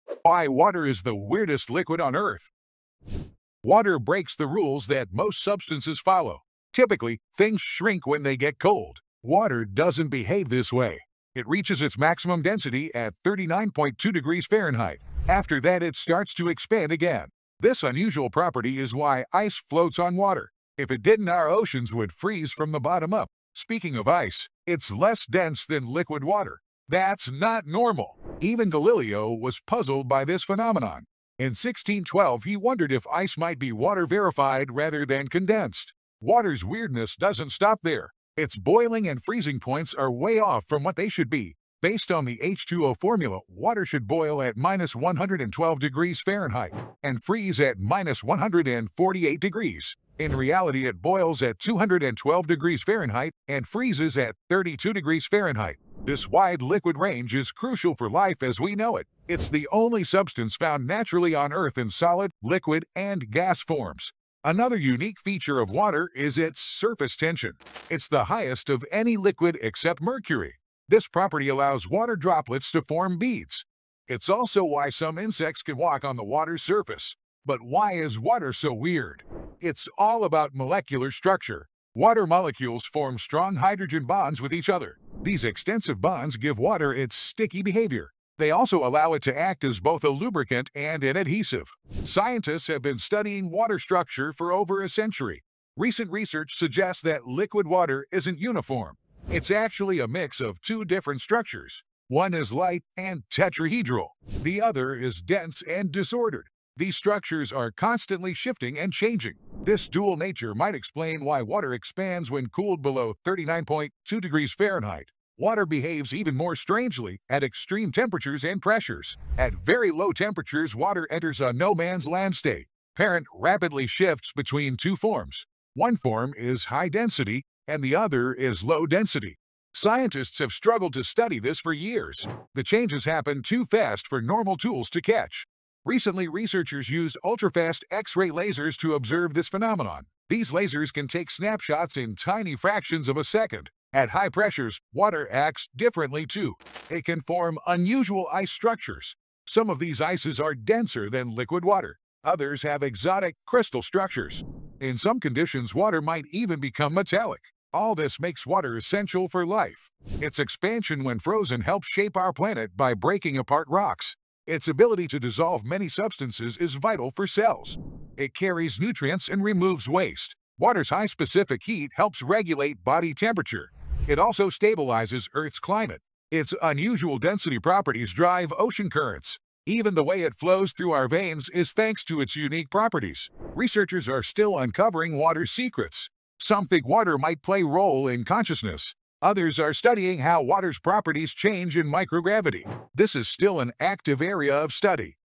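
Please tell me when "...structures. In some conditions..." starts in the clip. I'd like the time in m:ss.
2:33.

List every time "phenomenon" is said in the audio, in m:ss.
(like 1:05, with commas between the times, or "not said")
0:30, 2:19.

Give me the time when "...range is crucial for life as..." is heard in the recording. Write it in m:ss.
0:56.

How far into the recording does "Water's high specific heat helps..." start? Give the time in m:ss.
2:50.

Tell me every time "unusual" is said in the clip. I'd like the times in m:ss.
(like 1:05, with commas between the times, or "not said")
0:17, 2:27, 2:56.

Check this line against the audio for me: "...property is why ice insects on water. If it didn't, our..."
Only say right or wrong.
wrong.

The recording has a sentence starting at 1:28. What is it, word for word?
They also allow it to act as both a lubricant and an adhesive.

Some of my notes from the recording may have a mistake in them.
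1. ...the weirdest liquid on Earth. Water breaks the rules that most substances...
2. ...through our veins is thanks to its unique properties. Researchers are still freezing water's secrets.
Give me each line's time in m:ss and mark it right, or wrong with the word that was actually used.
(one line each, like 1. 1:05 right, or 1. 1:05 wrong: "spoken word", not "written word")
1. 0:01 right
2. 3:00 wrong: "uncovering", not "freezing".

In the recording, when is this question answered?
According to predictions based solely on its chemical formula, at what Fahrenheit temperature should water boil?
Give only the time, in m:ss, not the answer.
0:44.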